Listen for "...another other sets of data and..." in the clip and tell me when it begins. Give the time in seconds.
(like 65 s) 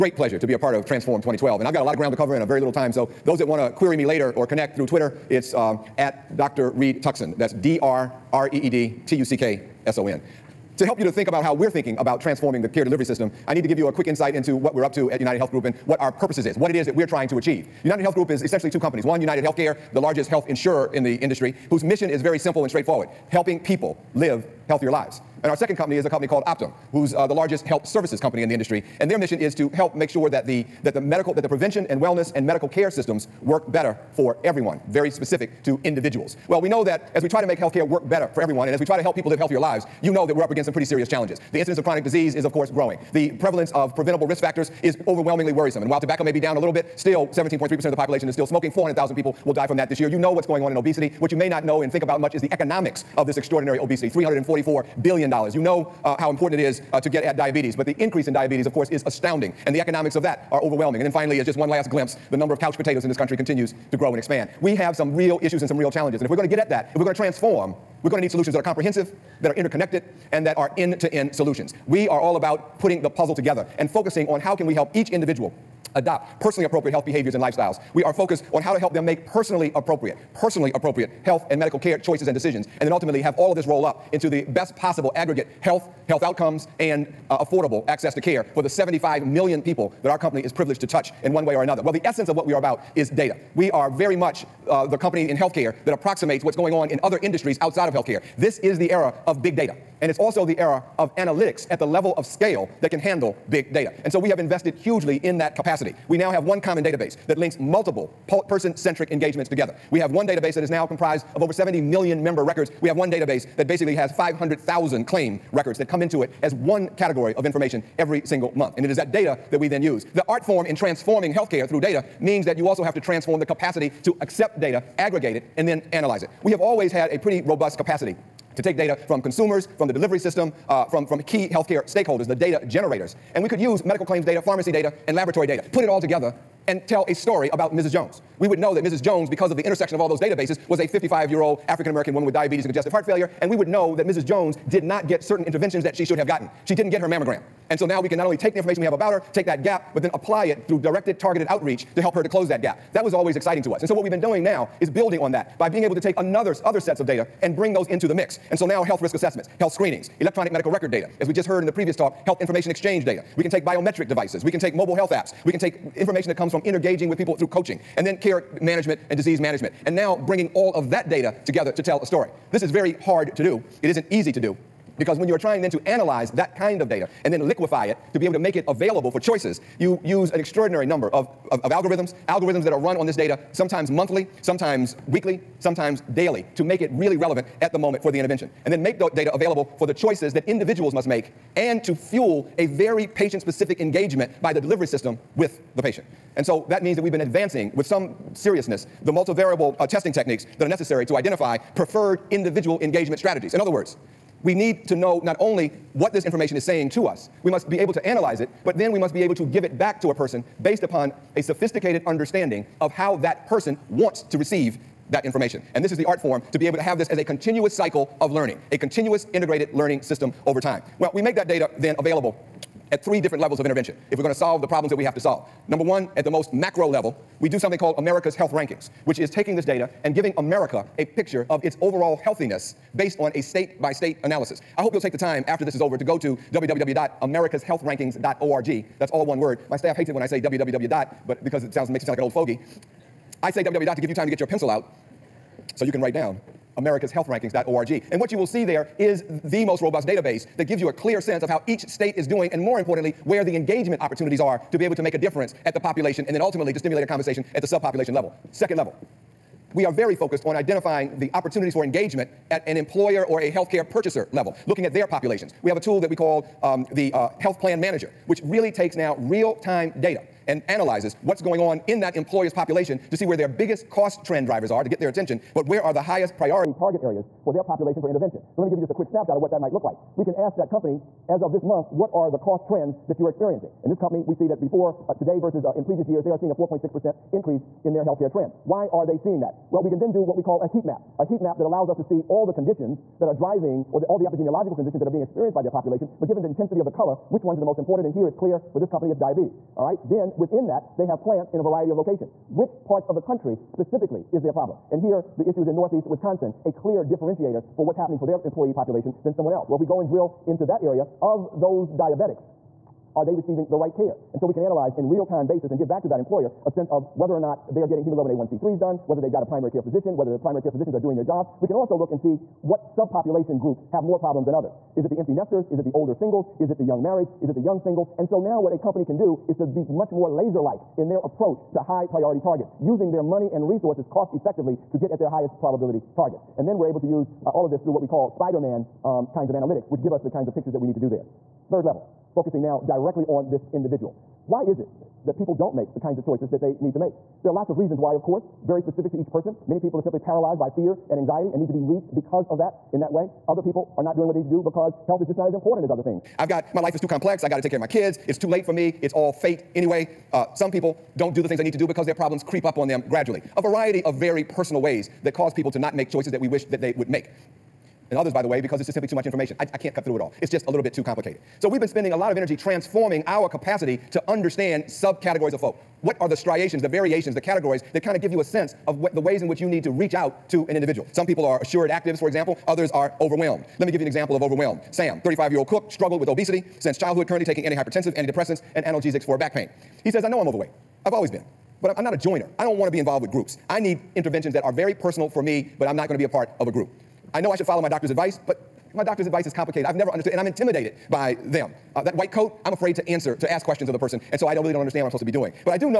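156 s.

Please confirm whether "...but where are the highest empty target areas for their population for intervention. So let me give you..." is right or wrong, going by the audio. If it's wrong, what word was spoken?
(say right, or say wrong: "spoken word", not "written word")
wrong: "priority", not "empty".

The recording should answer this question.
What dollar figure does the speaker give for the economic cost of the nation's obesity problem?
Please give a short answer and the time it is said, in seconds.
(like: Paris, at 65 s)
$344 billion, at 54 s.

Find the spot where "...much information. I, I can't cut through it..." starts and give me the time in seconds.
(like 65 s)
369 s.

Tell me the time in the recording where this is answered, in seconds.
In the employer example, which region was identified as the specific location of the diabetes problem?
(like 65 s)
305 s.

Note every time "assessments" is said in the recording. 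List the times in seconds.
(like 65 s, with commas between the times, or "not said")
159 s.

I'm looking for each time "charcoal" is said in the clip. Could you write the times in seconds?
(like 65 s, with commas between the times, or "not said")
not said.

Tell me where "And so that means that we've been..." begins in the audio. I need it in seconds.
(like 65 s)
196 s.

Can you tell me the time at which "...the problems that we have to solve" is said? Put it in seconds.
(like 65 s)
224 s.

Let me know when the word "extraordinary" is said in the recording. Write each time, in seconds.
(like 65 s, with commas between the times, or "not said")
53 s, 180 s.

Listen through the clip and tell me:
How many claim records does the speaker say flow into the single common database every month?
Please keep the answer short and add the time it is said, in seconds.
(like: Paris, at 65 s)
500,000, at 114 s.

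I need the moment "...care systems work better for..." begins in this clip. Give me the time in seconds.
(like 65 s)
32 s.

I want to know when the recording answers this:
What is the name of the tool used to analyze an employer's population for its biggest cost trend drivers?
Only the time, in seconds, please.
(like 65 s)
267 s.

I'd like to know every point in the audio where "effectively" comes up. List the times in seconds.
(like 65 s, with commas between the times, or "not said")
334 s.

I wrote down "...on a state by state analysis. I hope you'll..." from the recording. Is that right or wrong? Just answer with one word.
right.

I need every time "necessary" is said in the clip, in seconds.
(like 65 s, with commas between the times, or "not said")
200 s.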